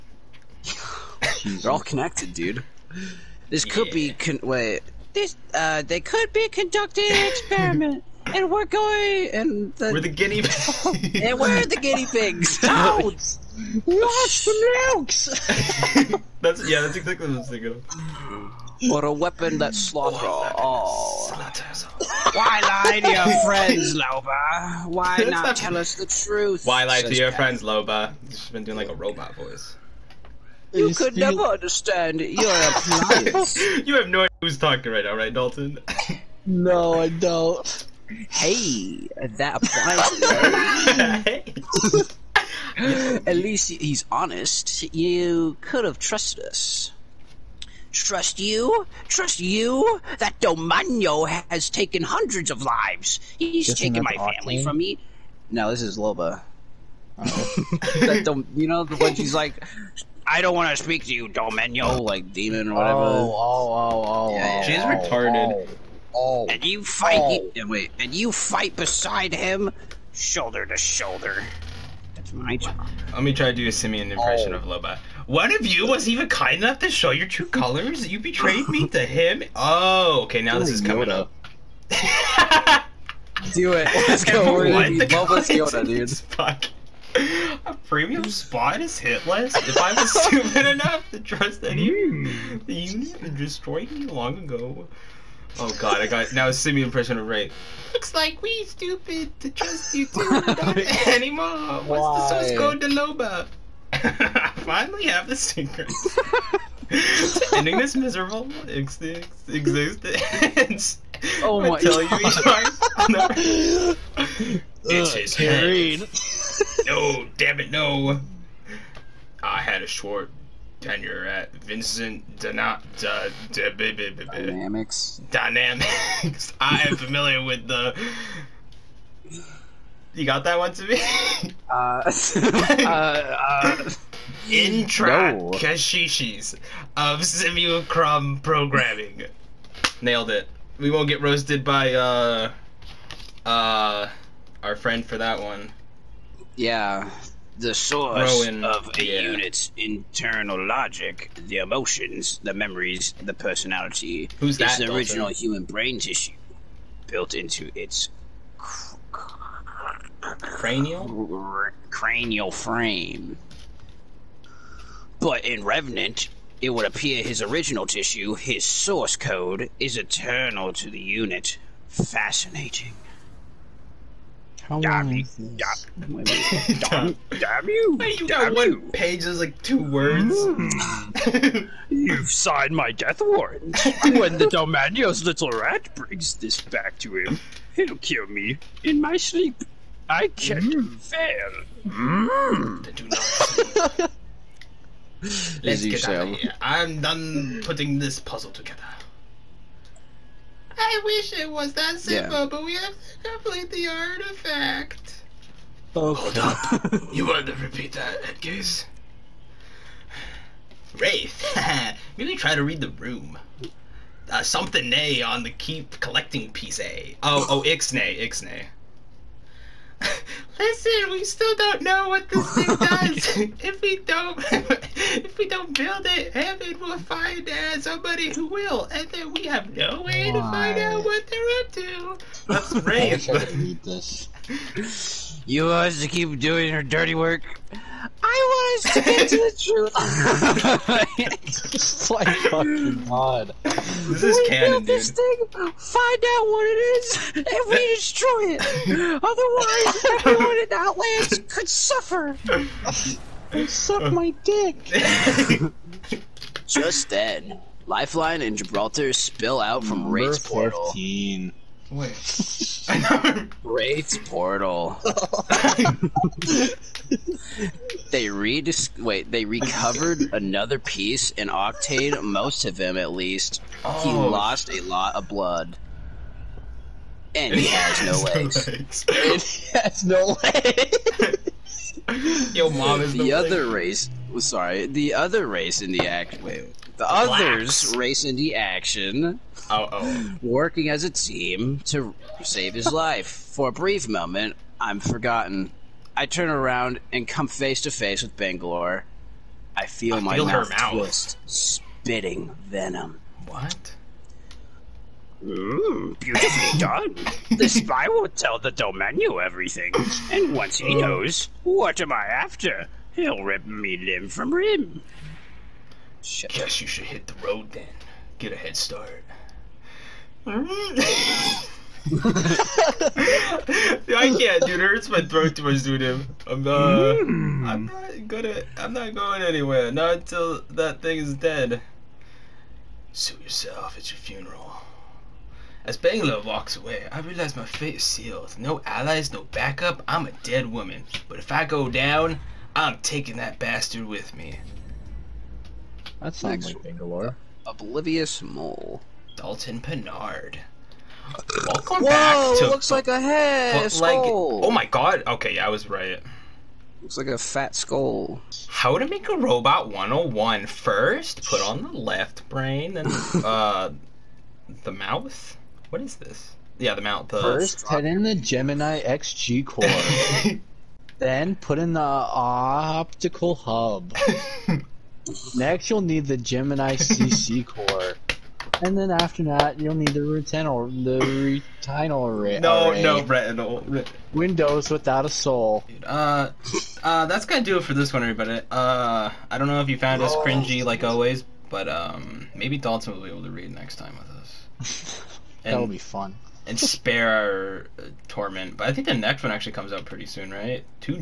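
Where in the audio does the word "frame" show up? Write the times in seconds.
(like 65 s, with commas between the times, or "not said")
162 s.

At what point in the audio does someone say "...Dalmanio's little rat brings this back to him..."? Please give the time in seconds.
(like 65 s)
184 s.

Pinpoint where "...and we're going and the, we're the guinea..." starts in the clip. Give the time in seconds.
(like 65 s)
8 s.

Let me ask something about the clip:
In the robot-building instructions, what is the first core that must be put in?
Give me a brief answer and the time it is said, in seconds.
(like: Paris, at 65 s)
Gemini XG core, at 368 s.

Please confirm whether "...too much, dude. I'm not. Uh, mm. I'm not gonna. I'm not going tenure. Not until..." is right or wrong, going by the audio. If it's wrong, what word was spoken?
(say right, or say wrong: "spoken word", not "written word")
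wrong: "anywhere", not "tenure".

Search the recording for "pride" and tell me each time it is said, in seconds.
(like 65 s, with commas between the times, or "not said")
not said.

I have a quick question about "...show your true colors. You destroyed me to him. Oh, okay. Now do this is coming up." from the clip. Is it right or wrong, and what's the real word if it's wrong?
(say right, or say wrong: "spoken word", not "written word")
wrong: "betrayed", not "destroyed".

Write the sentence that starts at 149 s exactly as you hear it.
unit's internal logic, the emotions, the memories, the personality.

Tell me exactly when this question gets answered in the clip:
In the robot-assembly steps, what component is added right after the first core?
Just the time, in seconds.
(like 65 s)
372 s.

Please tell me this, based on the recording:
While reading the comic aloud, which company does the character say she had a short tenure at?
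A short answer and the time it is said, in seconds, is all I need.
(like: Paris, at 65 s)
Vinson Dynamics, at 121 s.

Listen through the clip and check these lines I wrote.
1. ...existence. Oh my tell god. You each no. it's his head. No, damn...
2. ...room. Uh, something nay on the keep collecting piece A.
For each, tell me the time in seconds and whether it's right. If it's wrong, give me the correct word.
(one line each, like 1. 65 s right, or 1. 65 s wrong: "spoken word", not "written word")
1. 109 s right
2. 212 s right.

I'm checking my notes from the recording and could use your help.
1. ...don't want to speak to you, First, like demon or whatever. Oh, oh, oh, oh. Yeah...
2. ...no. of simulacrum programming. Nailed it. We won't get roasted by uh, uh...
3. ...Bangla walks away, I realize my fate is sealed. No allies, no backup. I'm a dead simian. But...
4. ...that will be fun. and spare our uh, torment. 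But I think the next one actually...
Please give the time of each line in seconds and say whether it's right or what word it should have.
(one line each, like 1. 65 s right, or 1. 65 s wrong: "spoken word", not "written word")
1. 60 s wrong: "Domeno", not "First"
2. 135 s right
3. 335 s wrong: "woman", not "simian"
4. 395 s right.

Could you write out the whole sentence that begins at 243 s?
This is we canon, this thing.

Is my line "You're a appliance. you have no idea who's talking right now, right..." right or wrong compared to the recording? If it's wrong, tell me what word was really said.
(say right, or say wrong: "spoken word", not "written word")
right.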